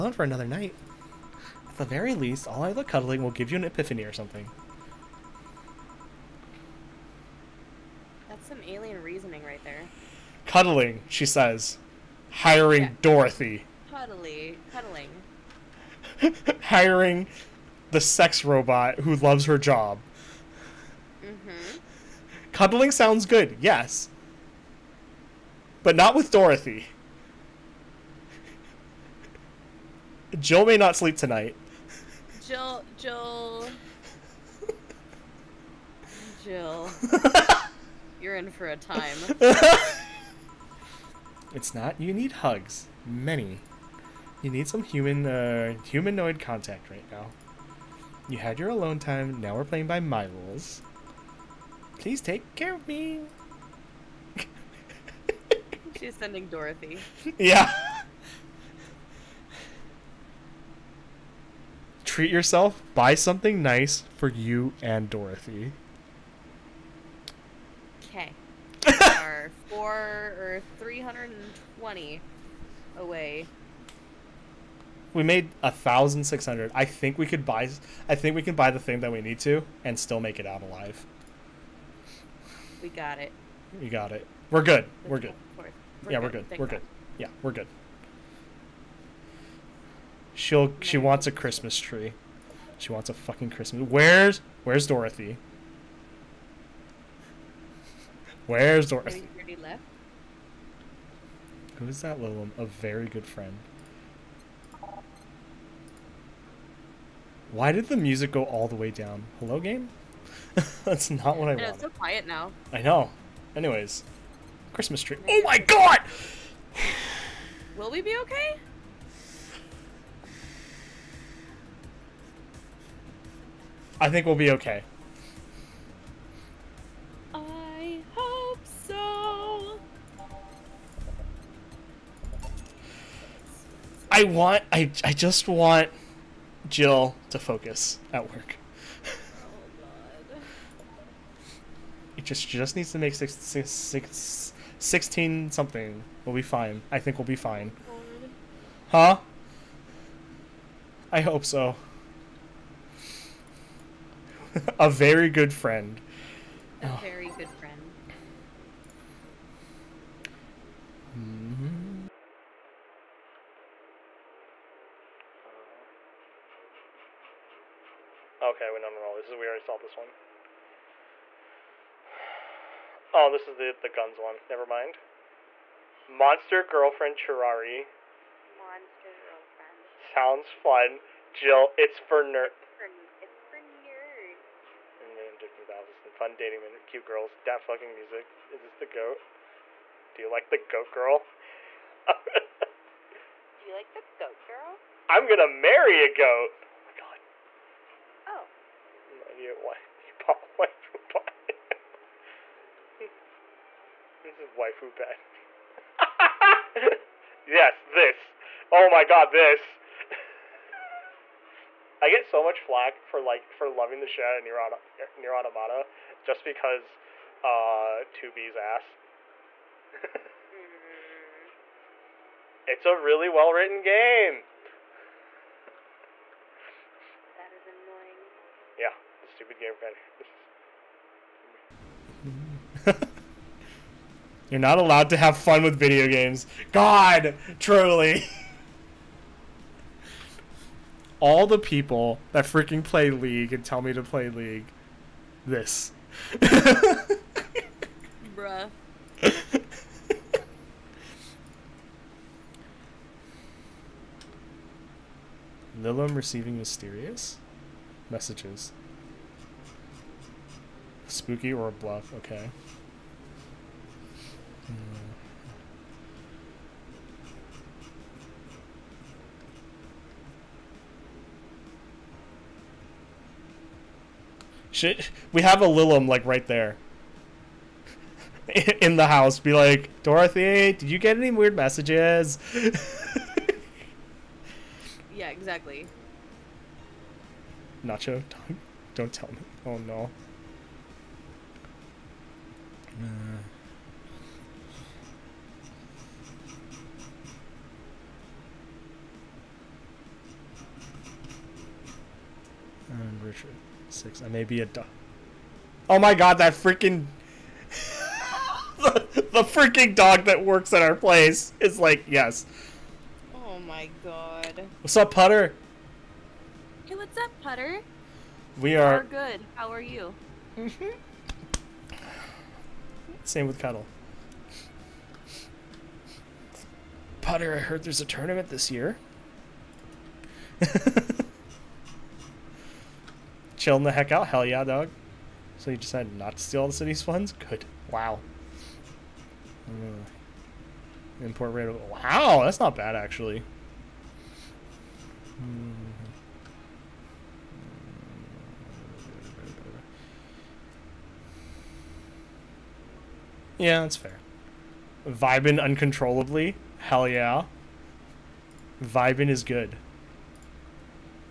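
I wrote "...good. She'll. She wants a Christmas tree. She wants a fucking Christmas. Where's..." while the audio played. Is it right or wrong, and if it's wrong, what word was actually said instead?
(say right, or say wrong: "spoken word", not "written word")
right.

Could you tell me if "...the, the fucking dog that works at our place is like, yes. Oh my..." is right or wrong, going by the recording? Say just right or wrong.
wrong.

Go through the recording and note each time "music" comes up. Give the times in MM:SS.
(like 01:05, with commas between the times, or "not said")
01:47, 03:07.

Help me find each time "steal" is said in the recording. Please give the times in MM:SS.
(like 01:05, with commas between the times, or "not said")
05:36.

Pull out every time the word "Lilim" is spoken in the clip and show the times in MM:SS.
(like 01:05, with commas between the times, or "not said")
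01:42, 04:15, 04:35.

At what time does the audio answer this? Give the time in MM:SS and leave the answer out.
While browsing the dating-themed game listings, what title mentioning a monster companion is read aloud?
02:56.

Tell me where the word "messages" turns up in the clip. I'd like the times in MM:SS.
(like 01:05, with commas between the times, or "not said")
04:18, 04:41.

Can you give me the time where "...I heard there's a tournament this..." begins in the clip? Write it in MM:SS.
05:27.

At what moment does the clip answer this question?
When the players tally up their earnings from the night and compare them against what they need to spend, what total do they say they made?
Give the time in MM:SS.
01:15.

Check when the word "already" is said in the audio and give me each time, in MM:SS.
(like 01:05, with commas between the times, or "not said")
01:39, 02:49.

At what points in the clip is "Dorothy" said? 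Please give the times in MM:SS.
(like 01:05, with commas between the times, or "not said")
00:13, 00:26, 00:56, 01:05, 01:34, 01:38, 04:40.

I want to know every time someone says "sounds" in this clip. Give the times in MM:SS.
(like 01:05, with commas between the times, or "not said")
00:22, 02:59.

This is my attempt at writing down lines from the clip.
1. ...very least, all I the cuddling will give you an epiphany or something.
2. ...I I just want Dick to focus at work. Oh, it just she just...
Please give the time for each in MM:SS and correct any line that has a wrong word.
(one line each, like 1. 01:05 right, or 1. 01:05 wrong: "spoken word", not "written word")
1. 00:01 right
2. 02:14 wrong: "Jill", not "Dick".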